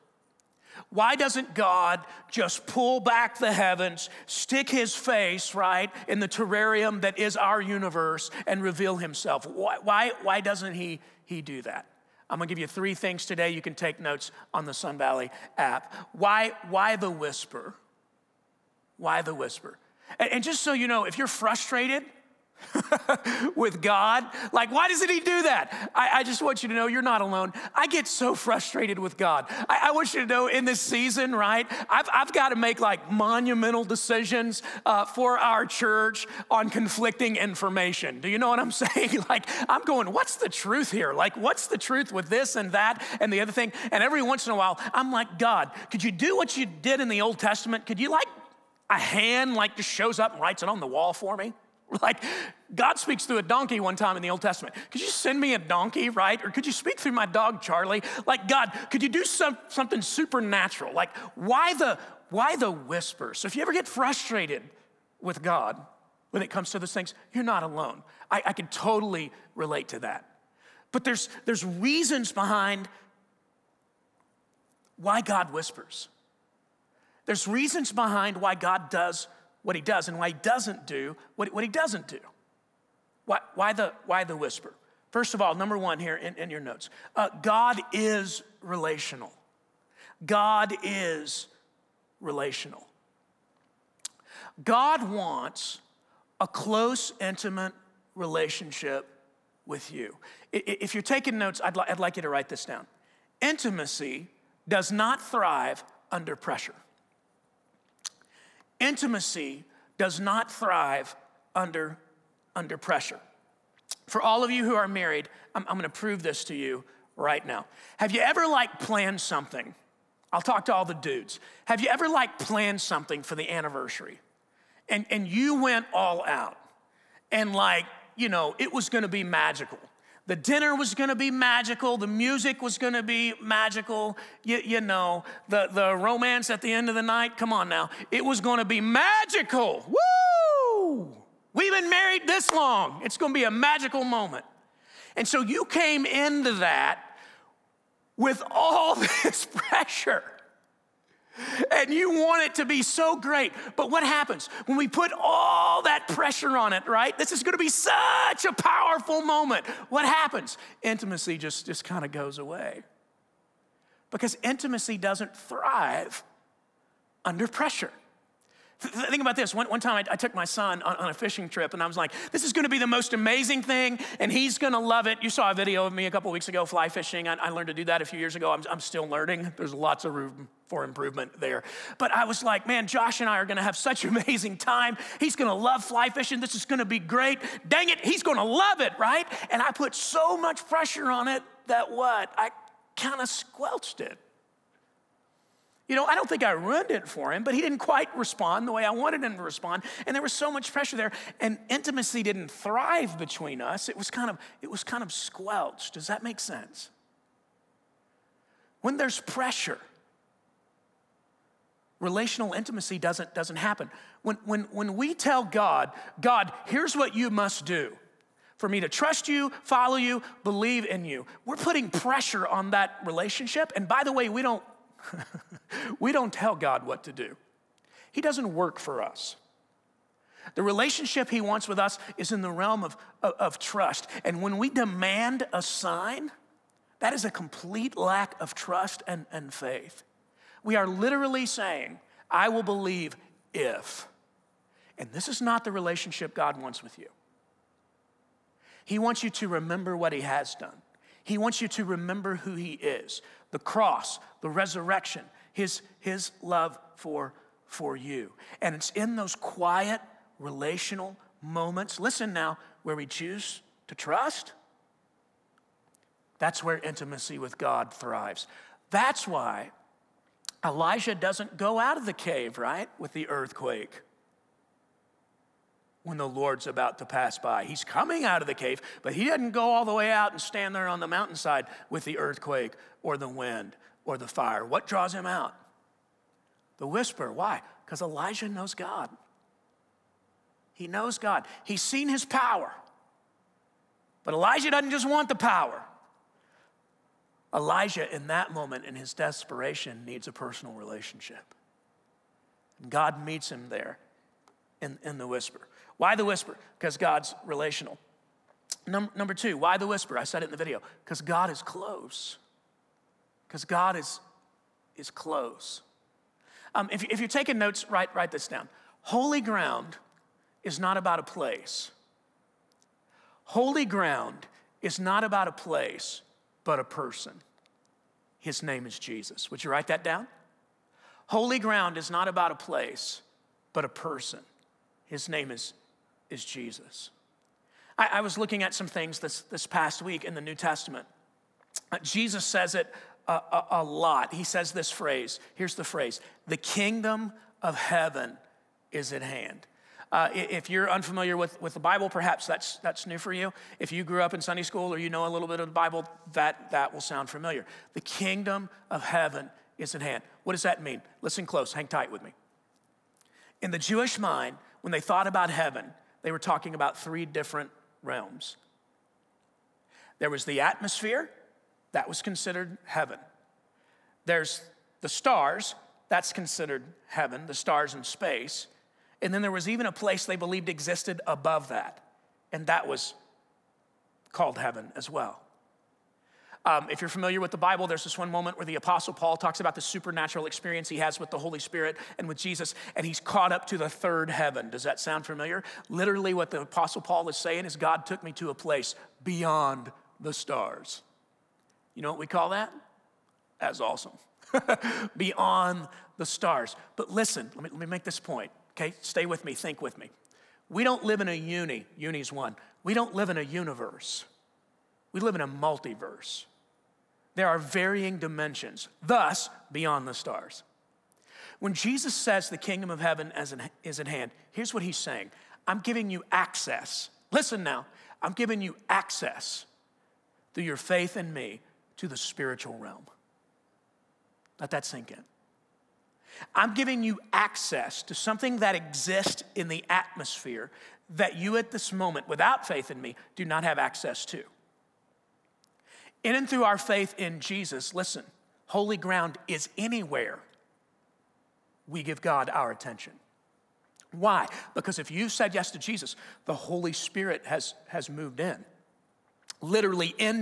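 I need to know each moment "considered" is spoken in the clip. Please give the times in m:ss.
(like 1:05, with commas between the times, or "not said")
6:12, 6:16.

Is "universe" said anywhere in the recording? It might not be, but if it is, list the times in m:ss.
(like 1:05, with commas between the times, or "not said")
0:07, 6:53.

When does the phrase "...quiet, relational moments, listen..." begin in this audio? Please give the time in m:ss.
4:19.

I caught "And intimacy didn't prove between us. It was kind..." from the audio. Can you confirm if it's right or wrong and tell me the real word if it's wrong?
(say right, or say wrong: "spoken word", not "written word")
wrong: "thrive", not "prove".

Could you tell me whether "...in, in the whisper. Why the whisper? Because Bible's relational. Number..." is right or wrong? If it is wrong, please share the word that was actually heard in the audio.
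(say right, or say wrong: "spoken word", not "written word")
wrong: "God", not "Bible".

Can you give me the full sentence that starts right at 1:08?
I, I can totally relate to that.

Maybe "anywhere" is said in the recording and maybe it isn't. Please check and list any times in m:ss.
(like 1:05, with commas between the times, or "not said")
7:29.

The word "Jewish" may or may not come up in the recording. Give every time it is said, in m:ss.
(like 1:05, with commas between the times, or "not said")
6:03.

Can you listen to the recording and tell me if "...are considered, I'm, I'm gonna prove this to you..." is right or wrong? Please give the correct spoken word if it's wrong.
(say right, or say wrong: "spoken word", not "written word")
wrong: "married", not "considered".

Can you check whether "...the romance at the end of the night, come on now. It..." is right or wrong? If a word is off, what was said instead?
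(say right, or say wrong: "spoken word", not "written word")
right.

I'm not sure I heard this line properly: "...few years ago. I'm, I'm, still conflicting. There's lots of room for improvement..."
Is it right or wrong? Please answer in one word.
wrong.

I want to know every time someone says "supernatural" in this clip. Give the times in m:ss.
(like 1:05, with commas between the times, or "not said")
1:00, 6:29.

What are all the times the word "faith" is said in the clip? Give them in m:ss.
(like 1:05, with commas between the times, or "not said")
3:59, 7:10, 7:22, 7:26.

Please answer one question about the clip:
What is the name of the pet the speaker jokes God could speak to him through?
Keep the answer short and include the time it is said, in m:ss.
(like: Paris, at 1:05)
Charlie, at 0:57.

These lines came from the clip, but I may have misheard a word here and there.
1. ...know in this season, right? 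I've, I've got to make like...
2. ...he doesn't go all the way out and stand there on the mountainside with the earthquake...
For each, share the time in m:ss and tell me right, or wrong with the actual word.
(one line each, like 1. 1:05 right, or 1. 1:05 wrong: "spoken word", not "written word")
1. 0:30 right
2. 4:39 right.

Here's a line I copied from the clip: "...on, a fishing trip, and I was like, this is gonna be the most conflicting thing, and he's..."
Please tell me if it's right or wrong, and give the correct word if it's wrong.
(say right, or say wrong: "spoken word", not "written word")
wrong: "amazing", not "conflicting".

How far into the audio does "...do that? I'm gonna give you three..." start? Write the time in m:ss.
0:11.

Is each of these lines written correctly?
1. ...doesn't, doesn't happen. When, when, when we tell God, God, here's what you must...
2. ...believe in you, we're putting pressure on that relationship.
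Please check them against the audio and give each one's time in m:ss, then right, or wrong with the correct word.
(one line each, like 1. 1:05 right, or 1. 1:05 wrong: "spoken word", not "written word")
1. 3:32 right
2. 3:40 right.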